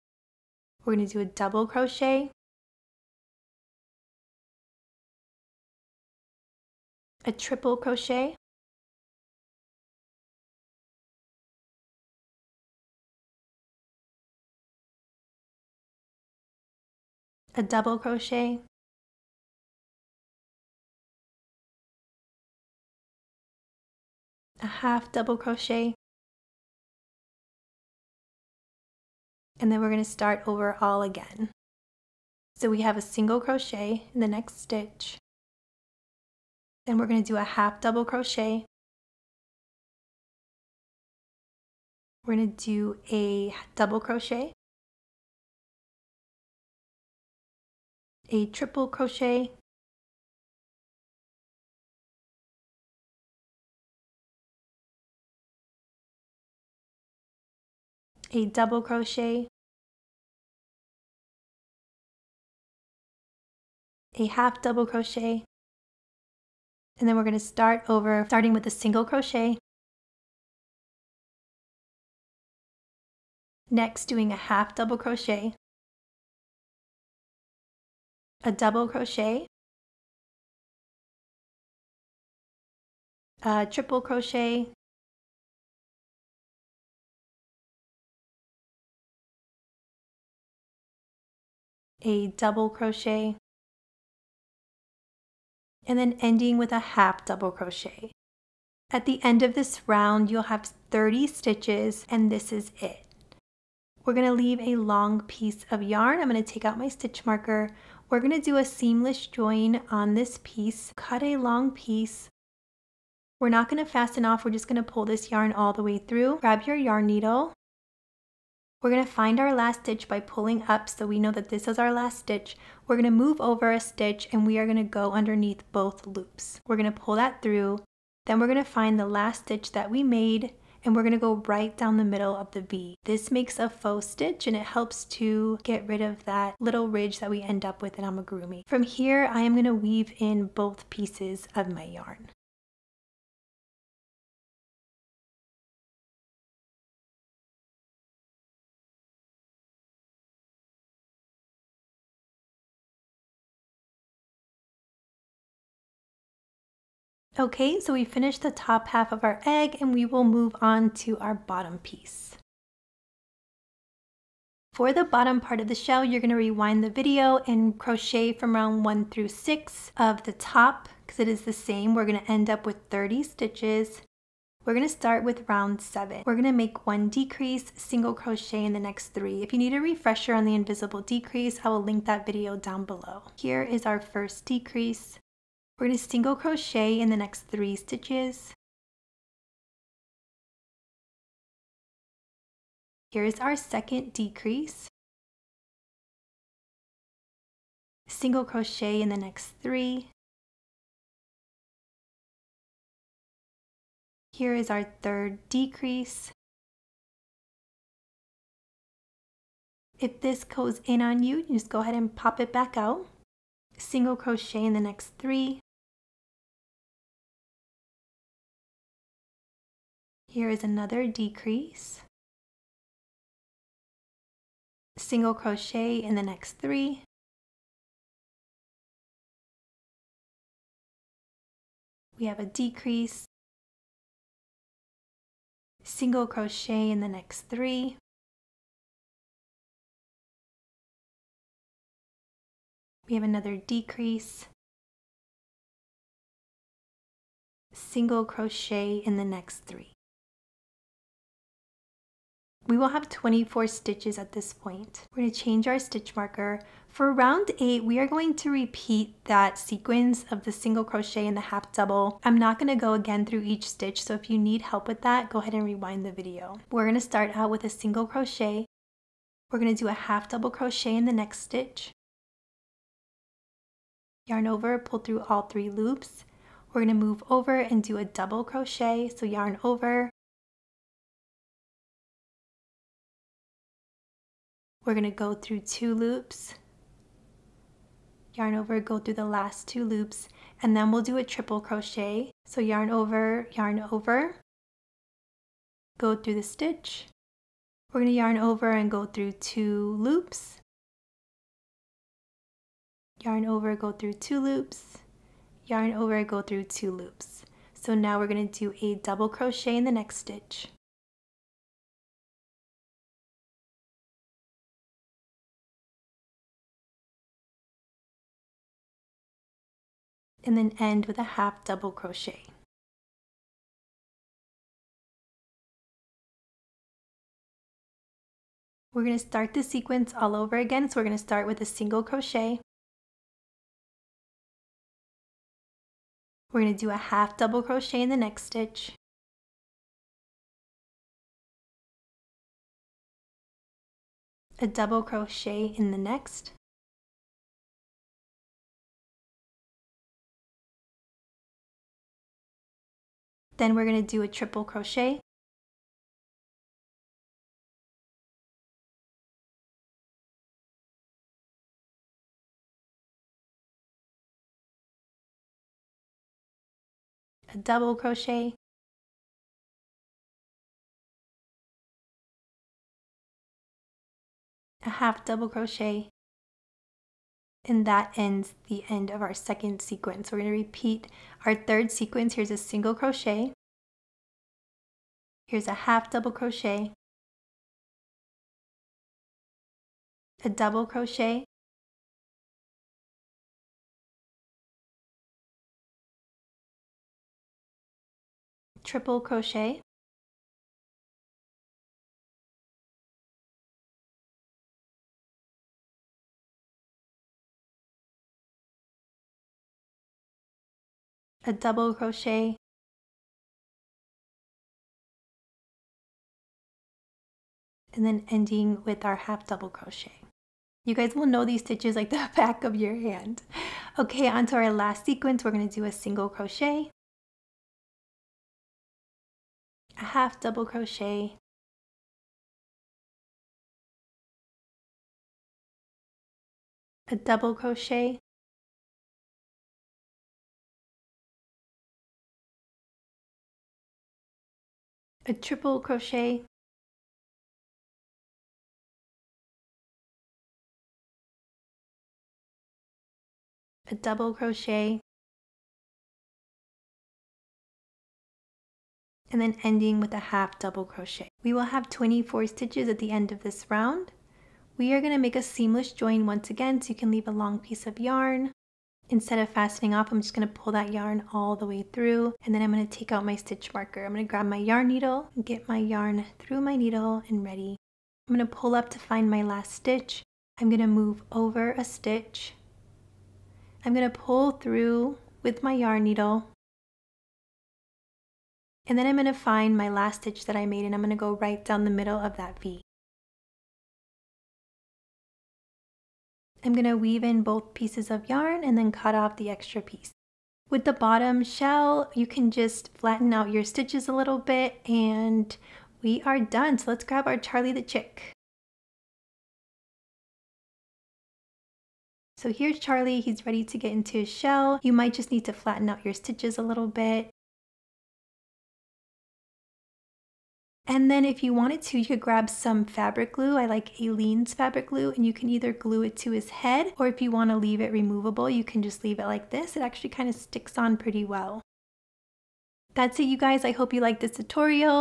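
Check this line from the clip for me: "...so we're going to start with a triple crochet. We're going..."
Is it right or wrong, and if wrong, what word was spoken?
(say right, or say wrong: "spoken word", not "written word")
wrong: "single", not "triple".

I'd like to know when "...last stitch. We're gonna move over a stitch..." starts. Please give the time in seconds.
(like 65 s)
121 s.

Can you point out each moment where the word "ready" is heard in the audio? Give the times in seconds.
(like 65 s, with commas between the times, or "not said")
477 s, 513 s.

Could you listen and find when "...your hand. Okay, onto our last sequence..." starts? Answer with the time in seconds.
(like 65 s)
422 s.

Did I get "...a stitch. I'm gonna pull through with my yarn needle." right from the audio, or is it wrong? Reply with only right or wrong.
right.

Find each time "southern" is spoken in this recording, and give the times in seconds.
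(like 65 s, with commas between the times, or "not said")
not said.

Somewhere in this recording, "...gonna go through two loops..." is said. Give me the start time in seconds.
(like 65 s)
284 s.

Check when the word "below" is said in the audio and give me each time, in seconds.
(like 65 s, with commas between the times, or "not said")
182 s.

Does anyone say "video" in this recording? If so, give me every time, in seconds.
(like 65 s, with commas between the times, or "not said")
166 s, 182 s, 266 s.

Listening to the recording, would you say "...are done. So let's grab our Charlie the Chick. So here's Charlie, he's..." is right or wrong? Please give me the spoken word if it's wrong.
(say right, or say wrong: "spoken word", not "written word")
right.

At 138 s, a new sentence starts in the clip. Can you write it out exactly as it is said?
From here, I am gonna weave in both pieces of my yarn.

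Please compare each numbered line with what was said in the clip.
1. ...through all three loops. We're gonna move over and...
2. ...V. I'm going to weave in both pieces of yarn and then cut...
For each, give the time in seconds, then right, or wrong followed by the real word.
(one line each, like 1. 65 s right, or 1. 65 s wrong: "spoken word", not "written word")
1. 274 s right
2. 492 s right.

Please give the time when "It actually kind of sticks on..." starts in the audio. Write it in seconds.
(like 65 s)
529 s.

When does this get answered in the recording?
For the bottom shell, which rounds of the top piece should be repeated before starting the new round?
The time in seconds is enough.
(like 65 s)
168 s.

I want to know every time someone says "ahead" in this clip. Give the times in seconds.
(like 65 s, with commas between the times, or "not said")
211 s, 265 s.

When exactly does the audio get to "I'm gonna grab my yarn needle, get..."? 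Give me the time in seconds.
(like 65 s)
474 s.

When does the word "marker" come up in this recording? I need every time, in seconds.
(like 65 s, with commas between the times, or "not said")
107 s, 256 s, 473 s.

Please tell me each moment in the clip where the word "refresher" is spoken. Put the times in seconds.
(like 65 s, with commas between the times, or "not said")
179 s.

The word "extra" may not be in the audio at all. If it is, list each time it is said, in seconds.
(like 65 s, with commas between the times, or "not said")
499 s.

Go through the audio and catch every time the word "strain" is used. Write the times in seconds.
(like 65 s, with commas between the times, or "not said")
not said.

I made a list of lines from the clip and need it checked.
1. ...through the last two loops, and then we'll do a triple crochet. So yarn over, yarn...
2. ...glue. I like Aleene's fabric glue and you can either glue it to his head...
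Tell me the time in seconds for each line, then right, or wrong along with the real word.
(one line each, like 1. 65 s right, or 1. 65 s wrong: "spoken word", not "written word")
1. 288 s right
2. 523 s right.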